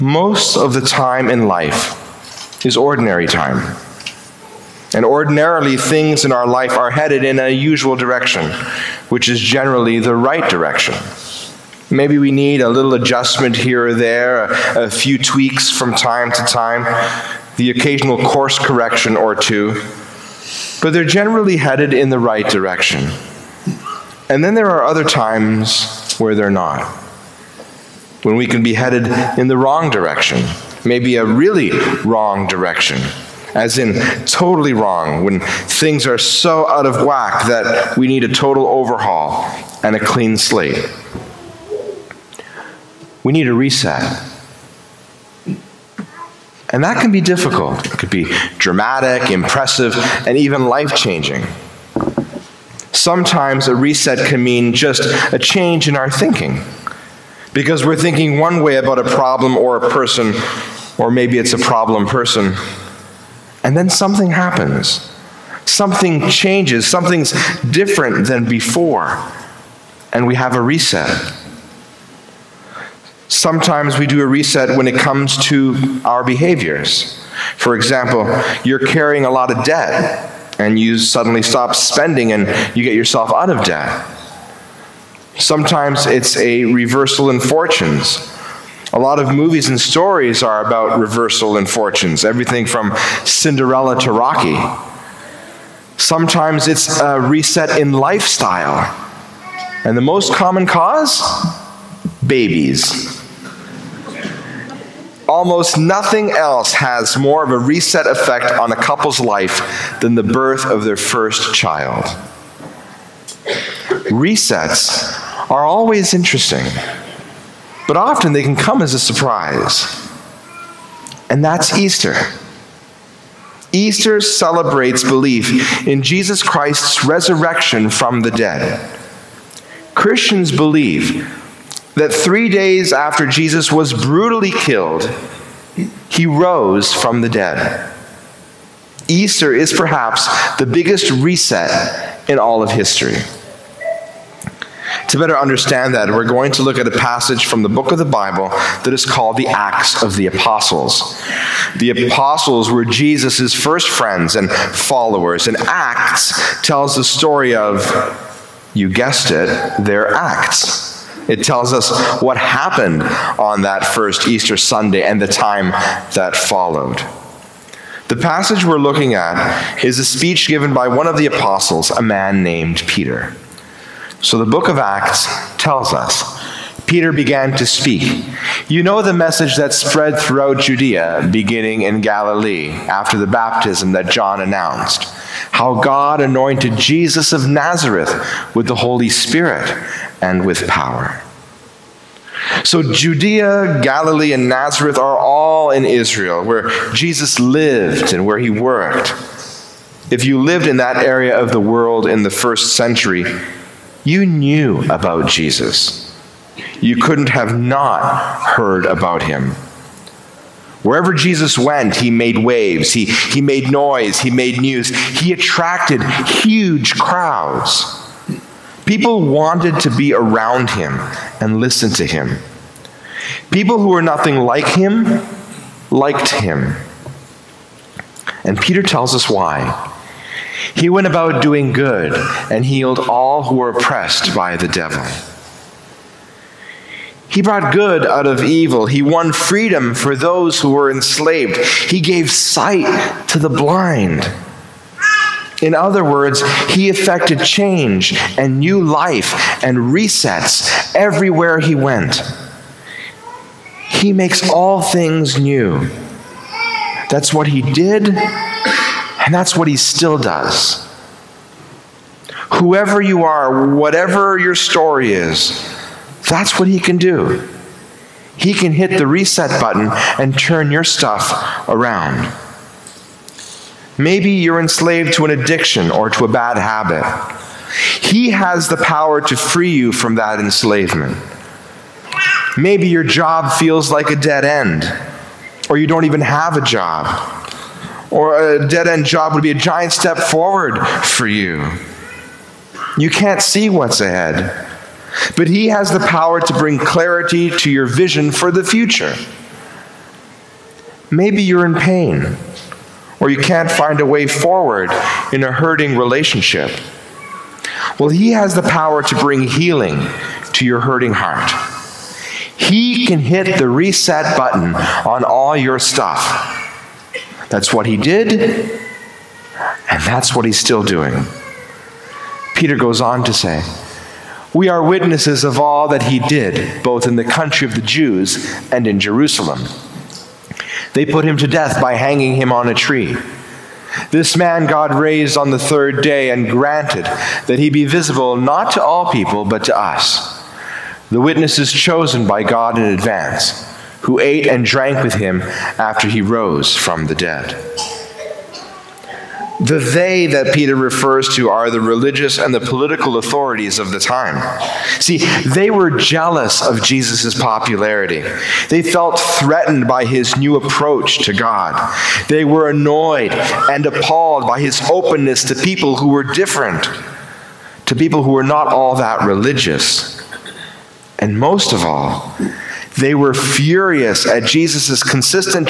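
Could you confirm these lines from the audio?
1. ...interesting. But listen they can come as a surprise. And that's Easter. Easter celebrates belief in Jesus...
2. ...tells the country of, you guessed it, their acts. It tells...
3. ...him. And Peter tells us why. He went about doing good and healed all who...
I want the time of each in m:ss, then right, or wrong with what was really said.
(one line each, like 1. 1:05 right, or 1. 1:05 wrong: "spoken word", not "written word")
1. 1:56 wrong: "often", not "listen"
2. 2:36 wrong: "story", not "country"
3. 3:46 right.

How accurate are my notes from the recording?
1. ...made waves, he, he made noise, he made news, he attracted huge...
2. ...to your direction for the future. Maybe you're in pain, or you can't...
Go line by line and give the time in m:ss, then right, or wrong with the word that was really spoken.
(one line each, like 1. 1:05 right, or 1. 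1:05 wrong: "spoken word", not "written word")
1. 3:32 right
2. 4:57 wrong: "vision", not "direction".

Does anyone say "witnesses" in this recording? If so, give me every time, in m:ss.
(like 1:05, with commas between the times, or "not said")
5:24, 5:41.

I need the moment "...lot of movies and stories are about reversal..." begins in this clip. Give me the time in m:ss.
1:28.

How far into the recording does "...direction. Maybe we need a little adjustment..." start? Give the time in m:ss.
0:10.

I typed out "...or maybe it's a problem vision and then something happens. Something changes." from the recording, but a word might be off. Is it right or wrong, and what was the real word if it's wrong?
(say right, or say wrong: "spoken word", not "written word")
wrong: "person", not "vision".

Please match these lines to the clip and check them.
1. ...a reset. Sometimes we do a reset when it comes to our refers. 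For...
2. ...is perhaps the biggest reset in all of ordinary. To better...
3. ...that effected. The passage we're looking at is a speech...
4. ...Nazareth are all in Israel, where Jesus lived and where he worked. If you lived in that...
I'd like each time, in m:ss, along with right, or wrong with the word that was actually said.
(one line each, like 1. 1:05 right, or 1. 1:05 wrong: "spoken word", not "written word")
1. 1:10 wrong: "behaviors", not "refers"
2. 2:19 wrong: "history", not "ordinary"
3. 2:46 wrong: "followed", not "effected"
4. 3:14 right.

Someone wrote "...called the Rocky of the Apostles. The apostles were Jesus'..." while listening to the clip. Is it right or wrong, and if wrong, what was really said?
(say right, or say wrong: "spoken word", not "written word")
wrong: "Acts", not "Rocky".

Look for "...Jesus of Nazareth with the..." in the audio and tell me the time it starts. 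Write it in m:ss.
3:06.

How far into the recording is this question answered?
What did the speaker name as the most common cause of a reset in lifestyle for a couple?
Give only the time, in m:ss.
1:42.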